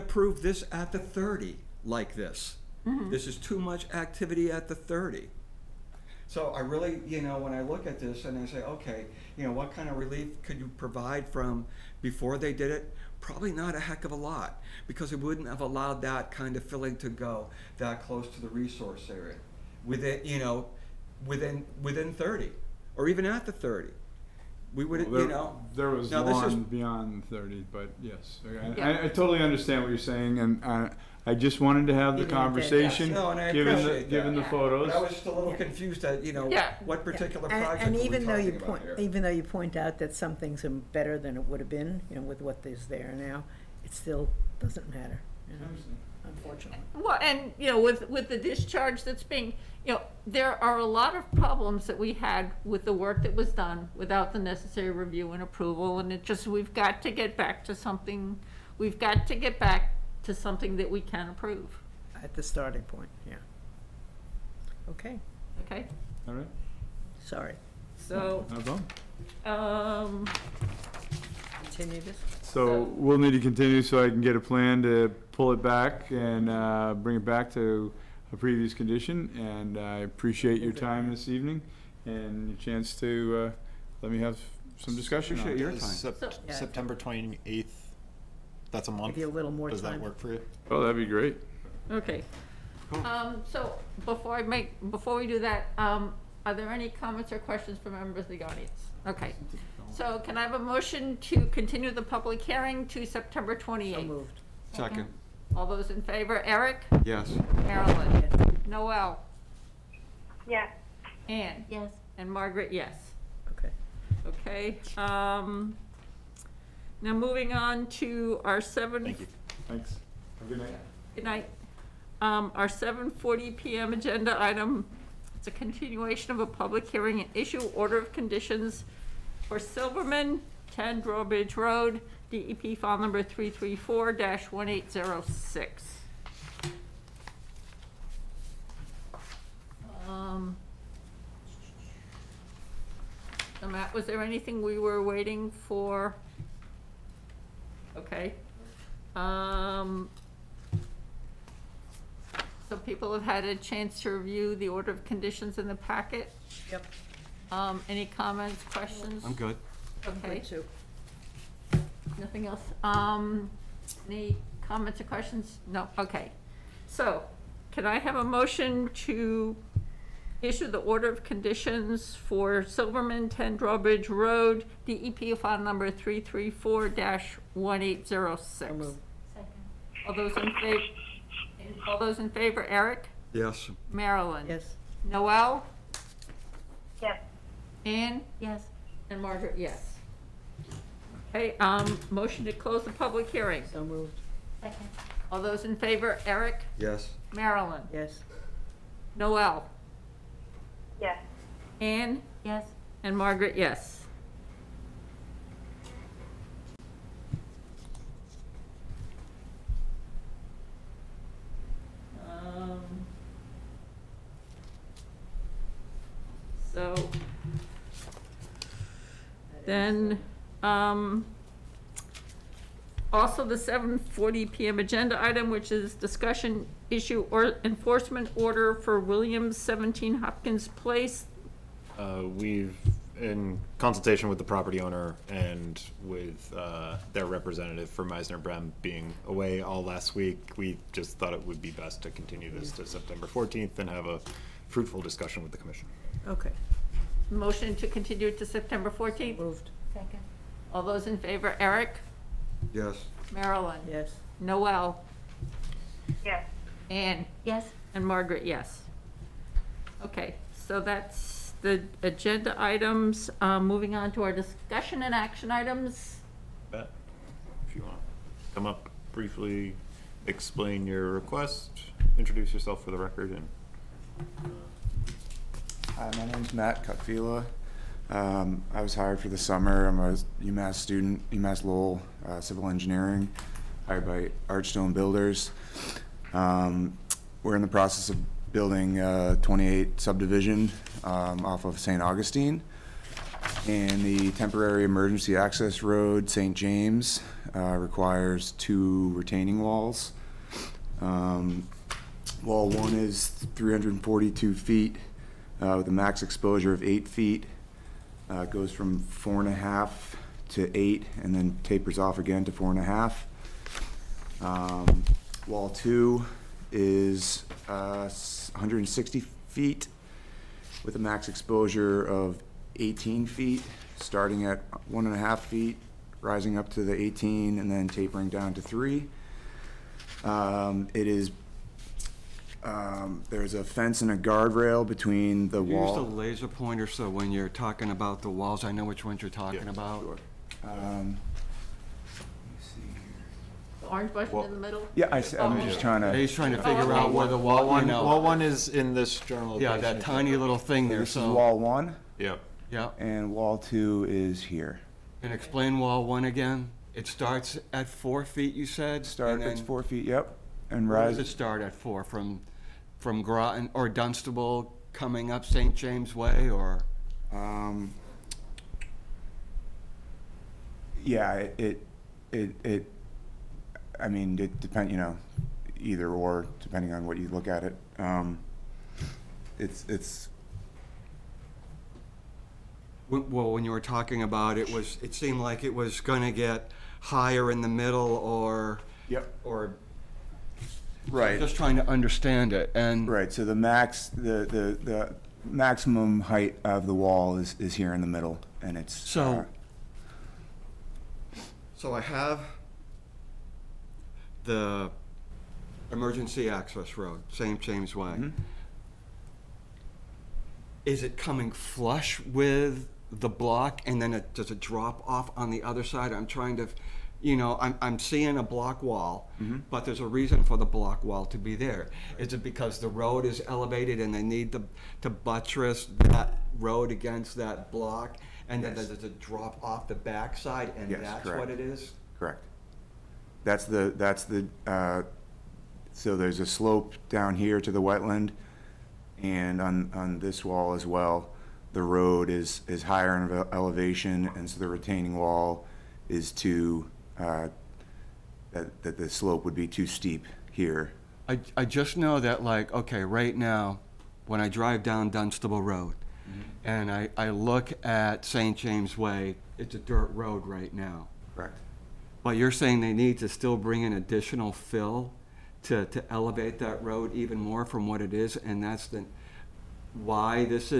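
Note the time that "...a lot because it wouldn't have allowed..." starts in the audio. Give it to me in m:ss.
0:14.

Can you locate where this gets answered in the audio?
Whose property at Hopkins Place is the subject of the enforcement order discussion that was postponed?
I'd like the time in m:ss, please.
3:48.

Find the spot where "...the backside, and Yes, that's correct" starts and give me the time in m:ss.
7:09.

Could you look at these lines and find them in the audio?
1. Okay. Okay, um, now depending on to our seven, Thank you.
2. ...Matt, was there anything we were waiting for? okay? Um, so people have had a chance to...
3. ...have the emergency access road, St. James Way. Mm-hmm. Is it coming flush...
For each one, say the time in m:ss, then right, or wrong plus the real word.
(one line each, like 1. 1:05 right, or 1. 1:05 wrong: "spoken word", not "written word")
1. 1:53 wrong: "moving", not "depending"
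2. 2:23 right
3. 6:42 right.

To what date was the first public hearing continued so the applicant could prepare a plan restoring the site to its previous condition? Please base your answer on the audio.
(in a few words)
September 28.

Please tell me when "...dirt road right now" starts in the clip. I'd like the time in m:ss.
7:39.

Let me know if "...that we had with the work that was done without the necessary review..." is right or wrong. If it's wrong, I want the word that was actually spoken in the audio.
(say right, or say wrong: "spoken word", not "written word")
right.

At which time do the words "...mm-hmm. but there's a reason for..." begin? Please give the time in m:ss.
6:59.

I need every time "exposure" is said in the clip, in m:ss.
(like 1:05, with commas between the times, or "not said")
5:06, 5:21.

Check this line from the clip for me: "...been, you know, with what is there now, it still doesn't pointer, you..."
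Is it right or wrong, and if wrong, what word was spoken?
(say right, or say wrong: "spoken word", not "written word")
wrong: "matter", not "pointer".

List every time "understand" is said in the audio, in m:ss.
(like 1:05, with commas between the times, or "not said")
0:29, 6:31.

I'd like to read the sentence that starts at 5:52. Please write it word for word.
Yeah, and wall two is here.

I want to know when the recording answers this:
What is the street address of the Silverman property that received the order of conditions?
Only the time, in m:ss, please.
2:10.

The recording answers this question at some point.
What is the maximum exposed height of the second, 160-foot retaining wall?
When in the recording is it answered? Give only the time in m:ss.
5:22.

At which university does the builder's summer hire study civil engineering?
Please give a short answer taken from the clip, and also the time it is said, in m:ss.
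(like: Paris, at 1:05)
UMass Lowell, at 4:41.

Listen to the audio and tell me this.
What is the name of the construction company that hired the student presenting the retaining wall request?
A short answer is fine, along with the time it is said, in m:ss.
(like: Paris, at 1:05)
Archstone Builders, at 4:44.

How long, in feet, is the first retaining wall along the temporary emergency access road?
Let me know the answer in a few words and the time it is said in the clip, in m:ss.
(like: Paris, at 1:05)
342 feet, at 5:03.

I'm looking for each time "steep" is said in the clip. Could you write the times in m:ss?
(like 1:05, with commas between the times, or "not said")
7:29.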